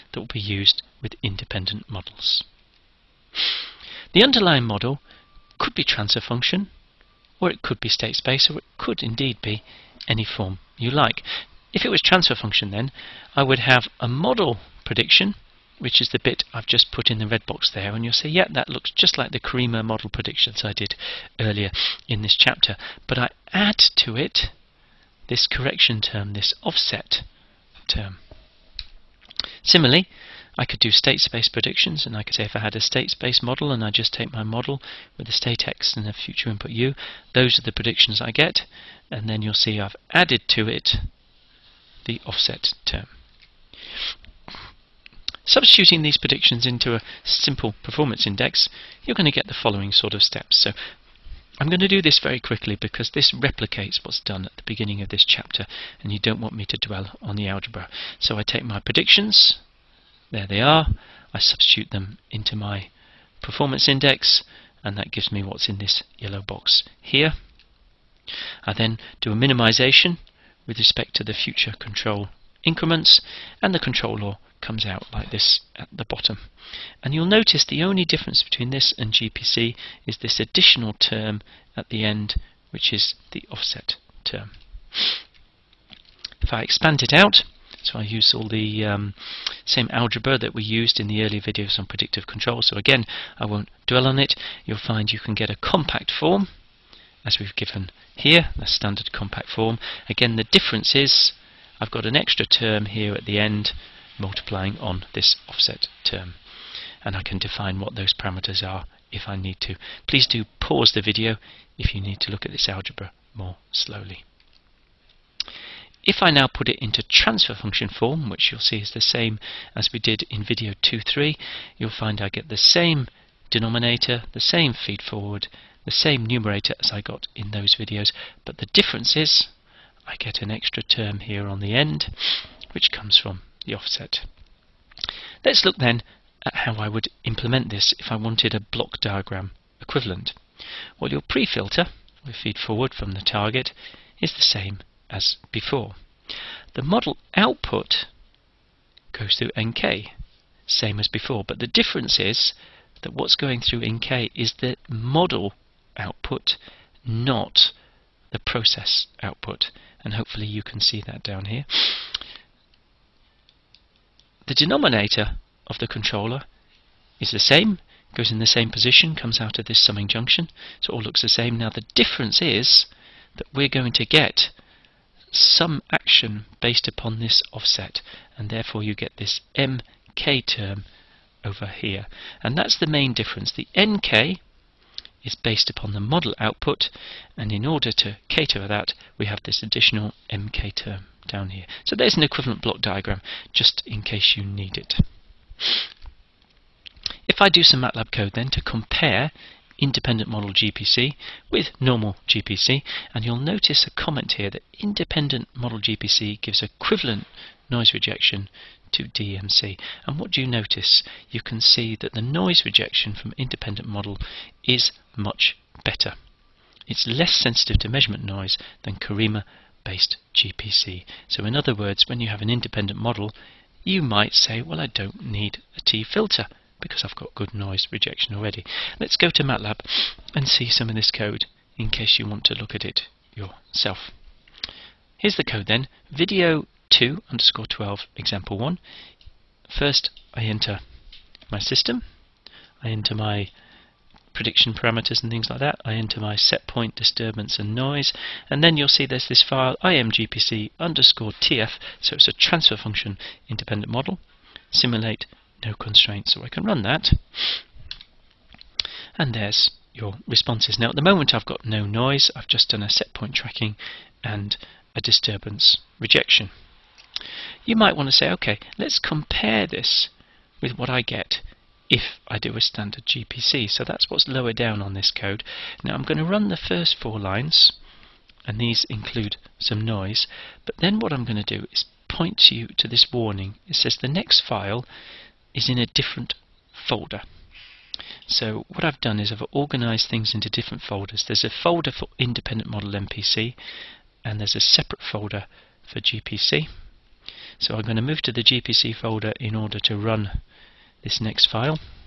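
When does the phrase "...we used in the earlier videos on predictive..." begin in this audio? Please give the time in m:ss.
1:30.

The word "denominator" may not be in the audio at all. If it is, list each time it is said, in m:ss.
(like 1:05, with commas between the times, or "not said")
2:03, 2:44.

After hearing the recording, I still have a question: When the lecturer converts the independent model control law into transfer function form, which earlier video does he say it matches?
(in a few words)
2.3.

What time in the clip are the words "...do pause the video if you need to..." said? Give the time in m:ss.
1:50.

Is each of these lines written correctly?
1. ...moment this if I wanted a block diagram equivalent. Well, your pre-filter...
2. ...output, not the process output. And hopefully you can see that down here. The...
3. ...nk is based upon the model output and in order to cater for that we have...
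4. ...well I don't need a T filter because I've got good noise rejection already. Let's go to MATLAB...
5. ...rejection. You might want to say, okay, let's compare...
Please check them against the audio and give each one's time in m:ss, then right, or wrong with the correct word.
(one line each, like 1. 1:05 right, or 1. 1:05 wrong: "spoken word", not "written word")
1. 2:17 wrong: "implement", not "moment"
2. 2:35 right
3. 3:03 right
4. 3:44 right
5. 4:25 right.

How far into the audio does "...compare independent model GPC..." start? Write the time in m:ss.
3:18.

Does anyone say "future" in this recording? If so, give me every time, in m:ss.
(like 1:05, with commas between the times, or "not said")
0:36, 1:11.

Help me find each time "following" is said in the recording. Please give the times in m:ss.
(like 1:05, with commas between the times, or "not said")
0:49.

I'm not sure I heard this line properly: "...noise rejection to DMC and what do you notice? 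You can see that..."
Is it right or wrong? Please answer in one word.
right.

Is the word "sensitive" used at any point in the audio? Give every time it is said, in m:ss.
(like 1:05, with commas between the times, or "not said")
3:37.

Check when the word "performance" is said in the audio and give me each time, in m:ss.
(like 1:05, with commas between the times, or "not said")
0:47, 1:03.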